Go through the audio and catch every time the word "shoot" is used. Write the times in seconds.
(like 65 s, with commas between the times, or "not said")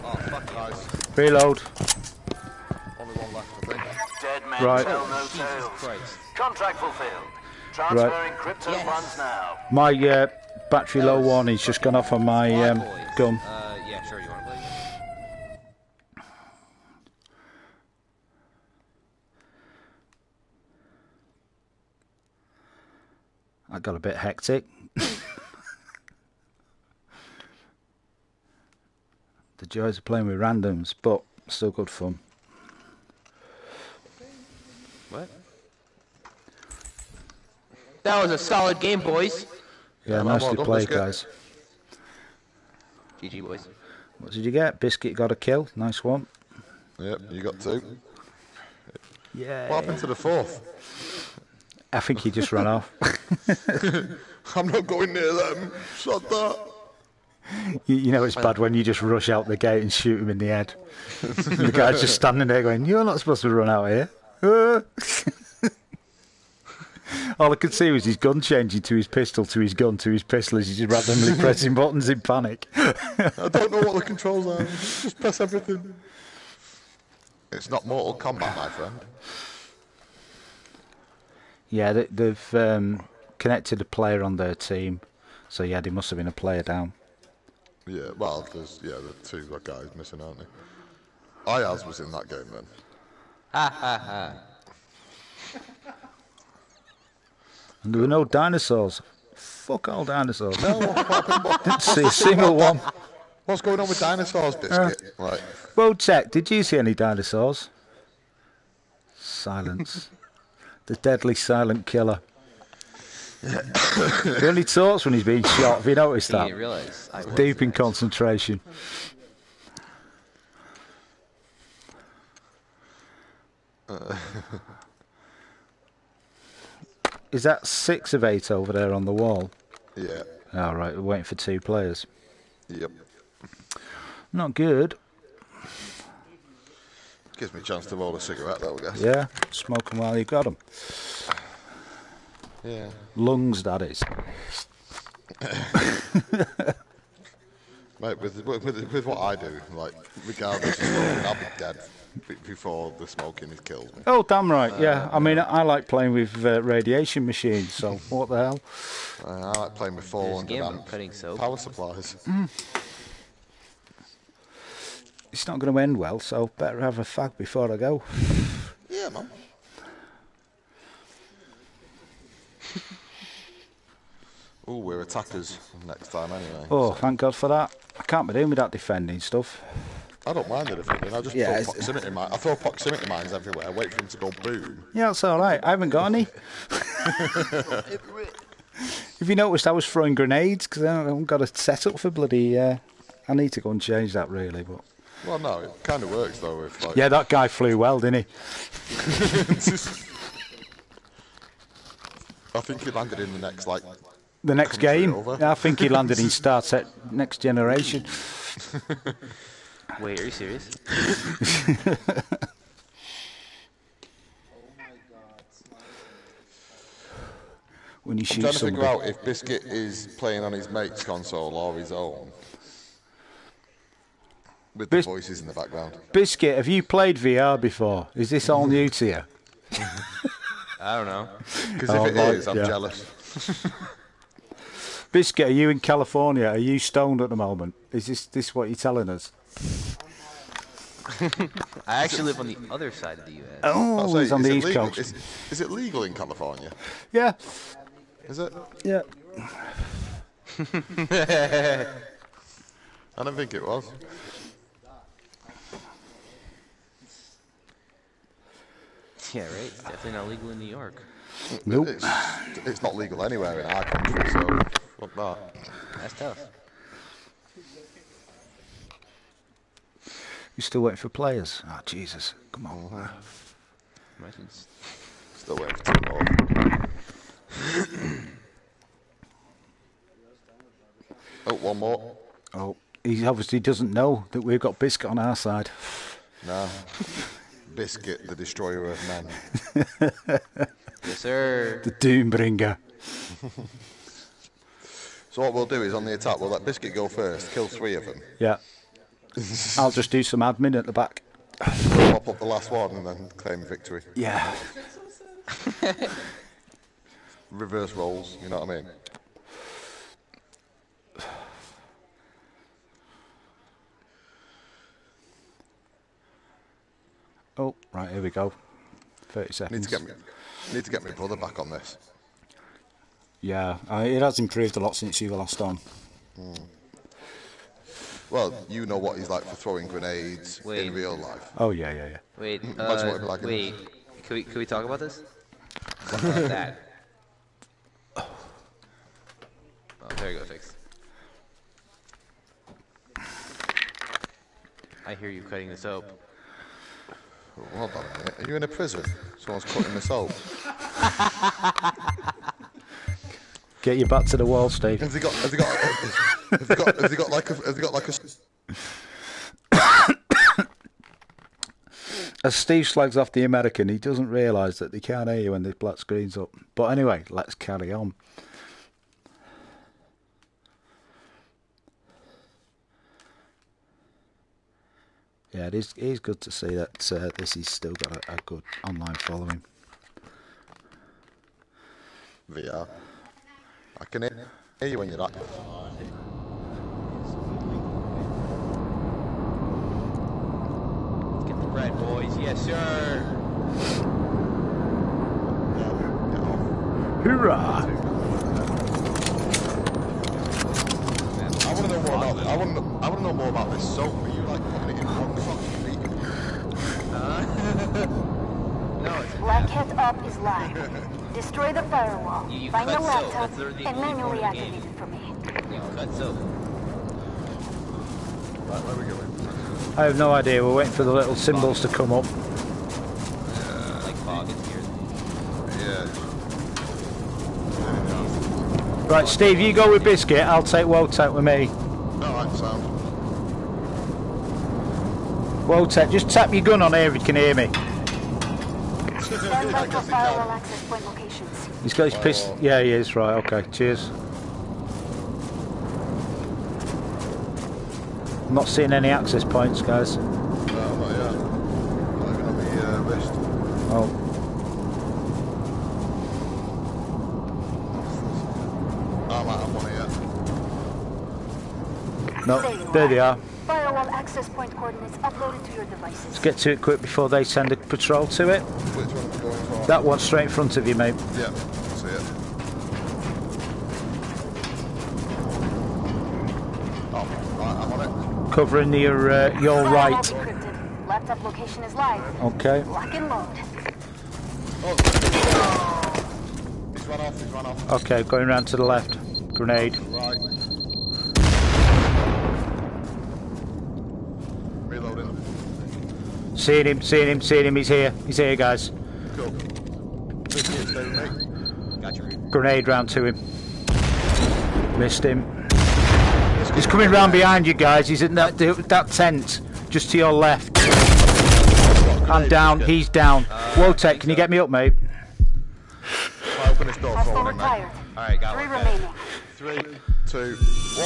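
59 s, 218 s.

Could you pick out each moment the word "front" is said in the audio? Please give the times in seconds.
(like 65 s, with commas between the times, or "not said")
470 s.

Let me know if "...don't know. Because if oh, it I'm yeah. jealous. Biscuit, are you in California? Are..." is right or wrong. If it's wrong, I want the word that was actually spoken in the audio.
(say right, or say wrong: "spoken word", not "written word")
right.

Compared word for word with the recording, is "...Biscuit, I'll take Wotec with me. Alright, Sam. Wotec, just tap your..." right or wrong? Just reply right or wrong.
right.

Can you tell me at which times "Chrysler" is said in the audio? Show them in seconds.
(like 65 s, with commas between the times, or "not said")
not said.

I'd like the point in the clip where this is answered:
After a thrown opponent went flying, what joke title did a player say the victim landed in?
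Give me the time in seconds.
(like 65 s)
206 s.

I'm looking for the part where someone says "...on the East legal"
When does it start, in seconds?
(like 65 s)
244 s.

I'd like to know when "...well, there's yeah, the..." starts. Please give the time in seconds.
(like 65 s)
88 s.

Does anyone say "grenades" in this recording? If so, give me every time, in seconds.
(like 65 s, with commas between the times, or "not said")
190 s, 329 s, 489 s, 502 s.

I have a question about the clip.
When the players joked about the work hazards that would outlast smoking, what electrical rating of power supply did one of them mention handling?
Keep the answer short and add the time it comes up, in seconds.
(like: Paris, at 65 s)
400 amp, at 160 s.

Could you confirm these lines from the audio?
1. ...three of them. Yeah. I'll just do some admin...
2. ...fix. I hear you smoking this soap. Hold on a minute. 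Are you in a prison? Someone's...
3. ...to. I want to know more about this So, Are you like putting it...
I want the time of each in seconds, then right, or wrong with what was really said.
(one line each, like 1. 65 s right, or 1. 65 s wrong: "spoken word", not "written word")
1. 297 s right
2. 340 s wrong: "cutting", not "smoking"
3. 402 s right.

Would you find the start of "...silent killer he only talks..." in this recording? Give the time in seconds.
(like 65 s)
111 s.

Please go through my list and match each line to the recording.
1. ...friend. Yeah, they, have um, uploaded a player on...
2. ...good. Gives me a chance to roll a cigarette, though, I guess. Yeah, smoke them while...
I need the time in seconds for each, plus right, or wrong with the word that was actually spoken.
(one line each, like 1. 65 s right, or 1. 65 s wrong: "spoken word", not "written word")
1. 78 s wrong: "connected", not "uploaded"
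2. 134 s right.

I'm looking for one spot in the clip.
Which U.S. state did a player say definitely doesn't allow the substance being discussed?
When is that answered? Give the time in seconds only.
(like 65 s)
260 s.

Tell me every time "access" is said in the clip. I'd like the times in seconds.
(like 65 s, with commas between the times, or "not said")
449 s, 464 s.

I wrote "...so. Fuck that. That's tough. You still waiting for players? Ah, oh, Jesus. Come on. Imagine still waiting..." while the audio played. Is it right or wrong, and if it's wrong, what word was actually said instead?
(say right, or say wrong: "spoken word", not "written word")
right.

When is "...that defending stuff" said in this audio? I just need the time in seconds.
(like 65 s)
178 s.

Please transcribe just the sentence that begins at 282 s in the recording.
Oh, he obviously doesn't know that we've got Biscuit on our side.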